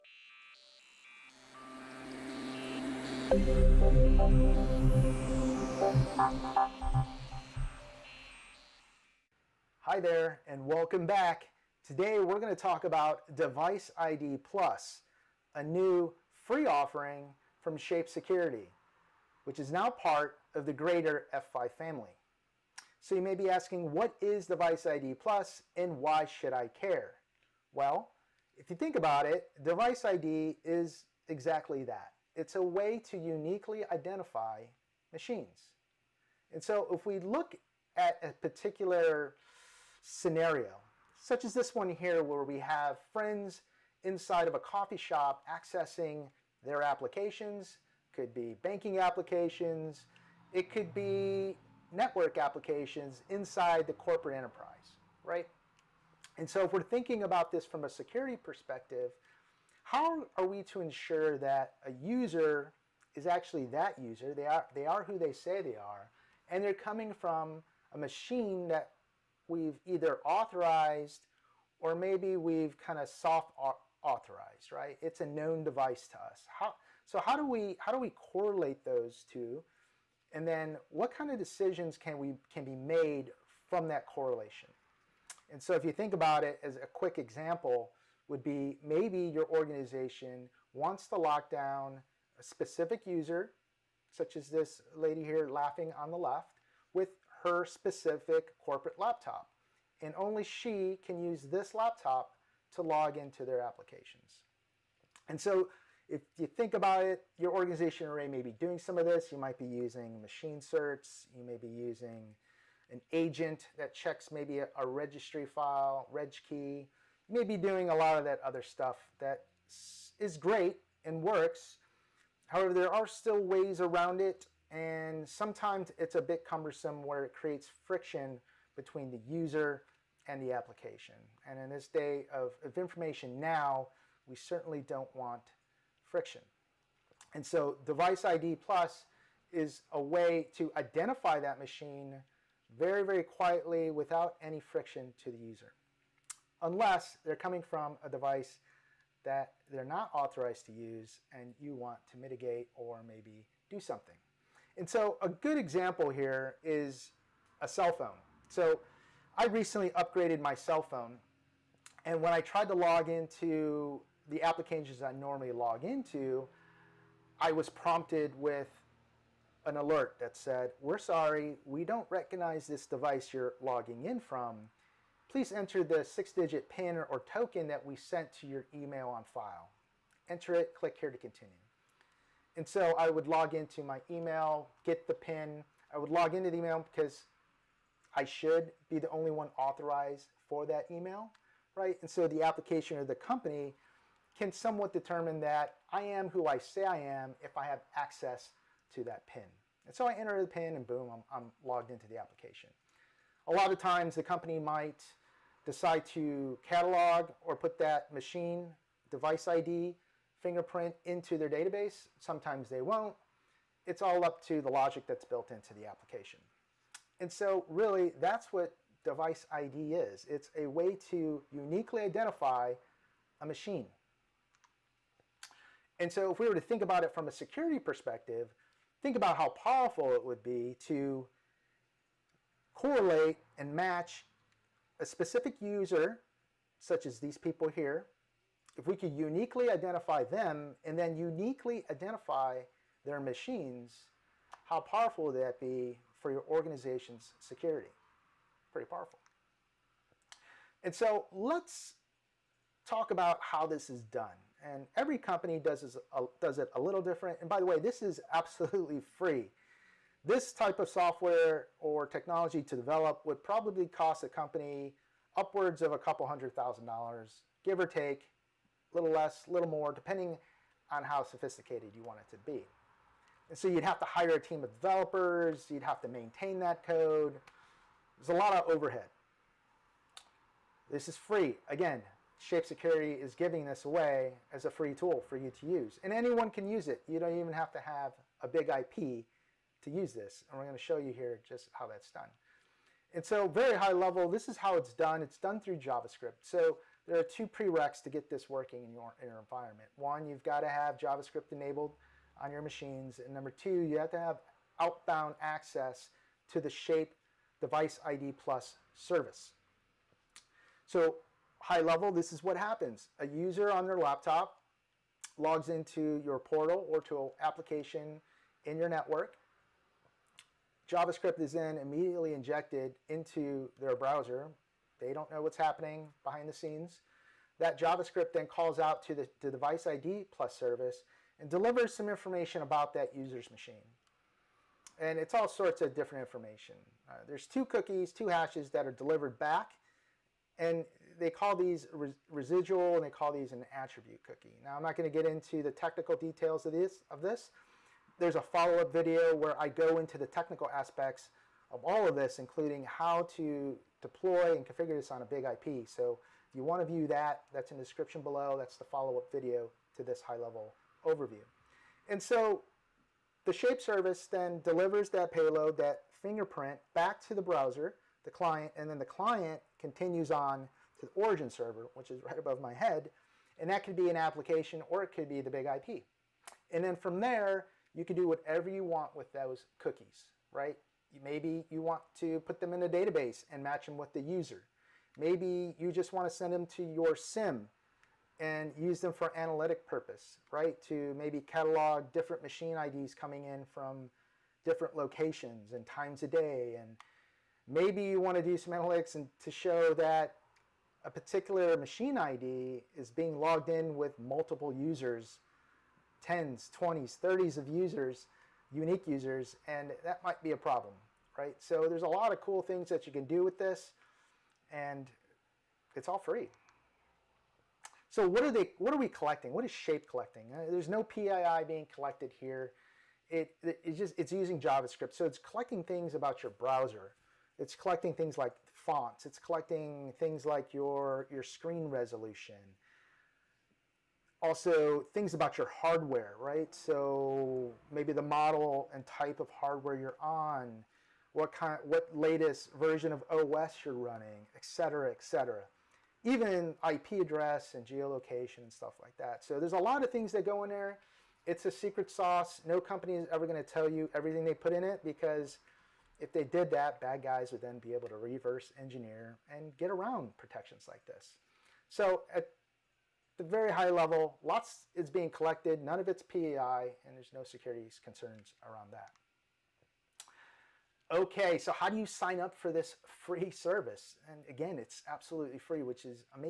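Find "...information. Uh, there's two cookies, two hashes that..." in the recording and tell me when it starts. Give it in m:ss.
5:36.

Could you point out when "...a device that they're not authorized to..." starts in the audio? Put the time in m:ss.
2:28.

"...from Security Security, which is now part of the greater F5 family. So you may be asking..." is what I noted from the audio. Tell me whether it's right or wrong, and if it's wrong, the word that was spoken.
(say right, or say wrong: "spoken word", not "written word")
wrong: "Shape", not "Security".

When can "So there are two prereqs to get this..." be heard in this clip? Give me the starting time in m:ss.
4:56.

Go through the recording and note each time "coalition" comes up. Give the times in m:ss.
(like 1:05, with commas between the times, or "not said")
not said.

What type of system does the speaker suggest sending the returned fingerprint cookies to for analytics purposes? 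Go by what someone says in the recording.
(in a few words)
SIEM.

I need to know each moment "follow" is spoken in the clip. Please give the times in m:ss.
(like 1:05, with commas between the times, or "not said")
5:48, 5:58.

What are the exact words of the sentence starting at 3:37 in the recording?
And so really, that's what device ID is.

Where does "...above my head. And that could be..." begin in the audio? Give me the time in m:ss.
6:12.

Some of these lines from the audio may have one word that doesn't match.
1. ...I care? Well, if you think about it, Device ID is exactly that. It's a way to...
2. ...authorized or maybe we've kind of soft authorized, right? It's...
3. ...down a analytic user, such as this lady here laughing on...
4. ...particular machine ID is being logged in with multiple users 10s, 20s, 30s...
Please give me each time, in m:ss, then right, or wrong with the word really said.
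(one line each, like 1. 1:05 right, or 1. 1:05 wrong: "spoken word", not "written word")
1. 0:26 right
2. 1:10 right
3. 1:31 wrong: "specific", not "analytic"
4. 6:41 right.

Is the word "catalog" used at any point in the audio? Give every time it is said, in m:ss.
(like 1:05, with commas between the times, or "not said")
3:26, 6:31.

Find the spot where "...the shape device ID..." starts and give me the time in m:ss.
5:06.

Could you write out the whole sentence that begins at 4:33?
And so you'd have to hire a team of developers, you'd have to maintain that code.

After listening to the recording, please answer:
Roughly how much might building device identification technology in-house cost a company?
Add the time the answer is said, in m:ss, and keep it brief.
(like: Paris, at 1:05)
A couple hundred thousand dollars, at 4:25.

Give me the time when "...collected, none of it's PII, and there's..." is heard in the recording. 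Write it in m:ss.
7:45.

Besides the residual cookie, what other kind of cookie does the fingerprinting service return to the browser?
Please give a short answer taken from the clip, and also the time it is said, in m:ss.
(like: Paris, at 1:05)
Attribute cookie, at 5:43.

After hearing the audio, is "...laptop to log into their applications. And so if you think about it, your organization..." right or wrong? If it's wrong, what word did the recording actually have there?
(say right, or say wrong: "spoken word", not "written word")
right.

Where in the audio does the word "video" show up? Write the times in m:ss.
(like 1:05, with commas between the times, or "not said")
5:48, 5:59.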